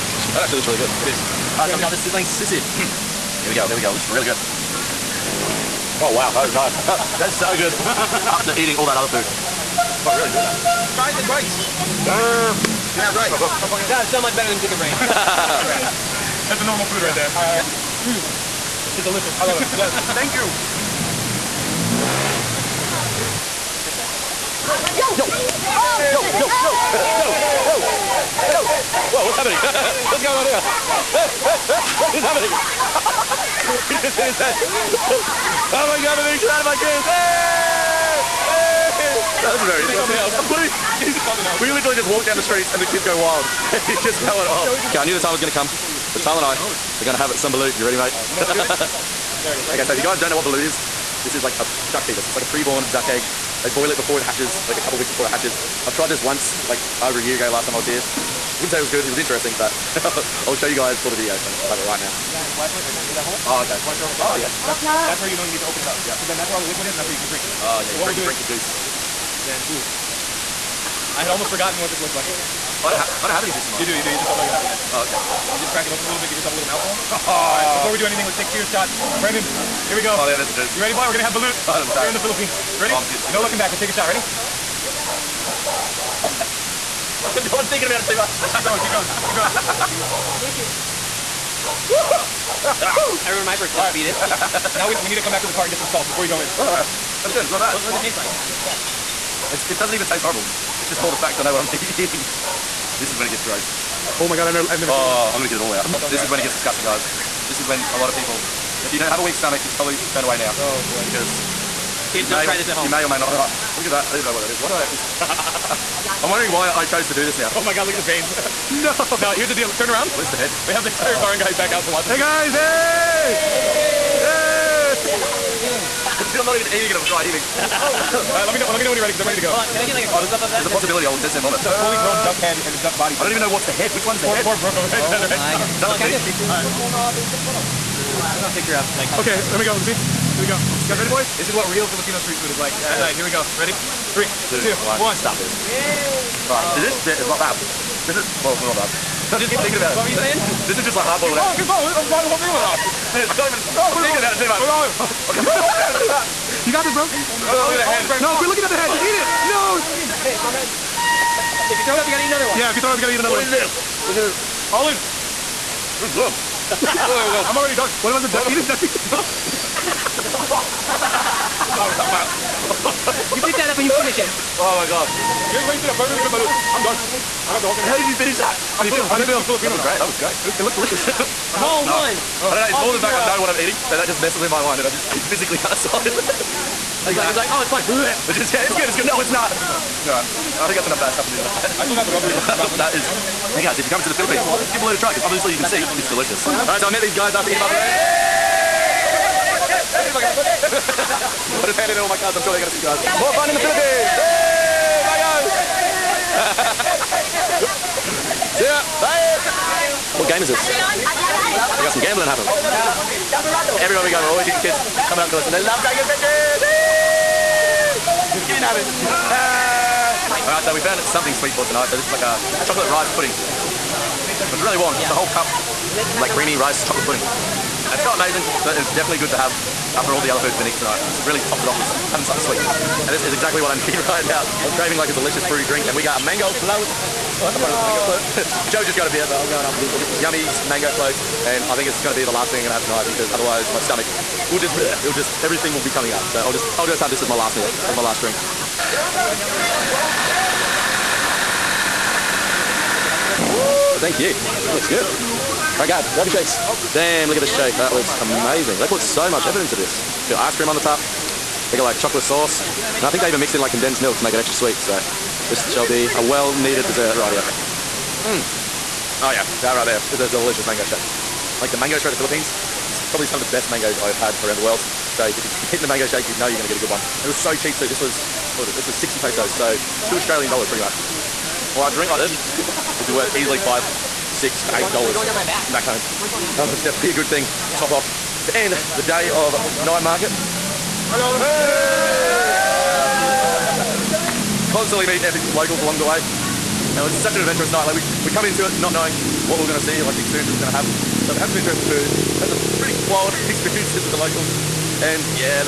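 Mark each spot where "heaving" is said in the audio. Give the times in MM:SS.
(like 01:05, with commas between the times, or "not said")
02:07.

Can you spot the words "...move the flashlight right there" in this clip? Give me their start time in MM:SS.
01:02.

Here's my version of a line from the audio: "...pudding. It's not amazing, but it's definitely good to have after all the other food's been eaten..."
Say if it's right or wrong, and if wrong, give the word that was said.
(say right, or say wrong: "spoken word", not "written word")
right.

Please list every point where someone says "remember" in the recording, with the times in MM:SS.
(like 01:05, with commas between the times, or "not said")
01:33.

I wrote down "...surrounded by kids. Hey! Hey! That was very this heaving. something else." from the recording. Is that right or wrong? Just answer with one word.
wrong.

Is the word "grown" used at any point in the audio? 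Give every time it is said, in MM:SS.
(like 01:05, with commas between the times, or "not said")
02:11.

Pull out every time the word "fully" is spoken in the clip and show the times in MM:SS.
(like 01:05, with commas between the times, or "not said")
02:11.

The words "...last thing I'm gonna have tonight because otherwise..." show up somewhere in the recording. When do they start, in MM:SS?
04:02.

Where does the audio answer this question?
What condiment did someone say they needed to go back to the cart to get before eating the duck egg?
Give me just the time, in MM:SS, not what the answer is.
01:35.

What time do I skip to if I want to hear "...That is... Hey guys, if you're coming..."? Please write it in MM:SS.
03:12.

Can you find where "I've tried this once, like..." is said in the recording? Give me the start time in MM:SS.
00:55.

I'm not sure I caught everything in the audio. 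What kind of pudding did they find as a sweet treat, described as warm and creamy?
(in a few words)
chocolate rice pudding.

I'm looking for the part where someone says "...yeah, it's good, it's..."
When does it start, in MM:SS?
03:08.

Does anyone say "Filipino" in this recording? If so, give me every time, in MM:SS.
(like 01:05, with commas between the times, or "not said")
02:21, 02:59.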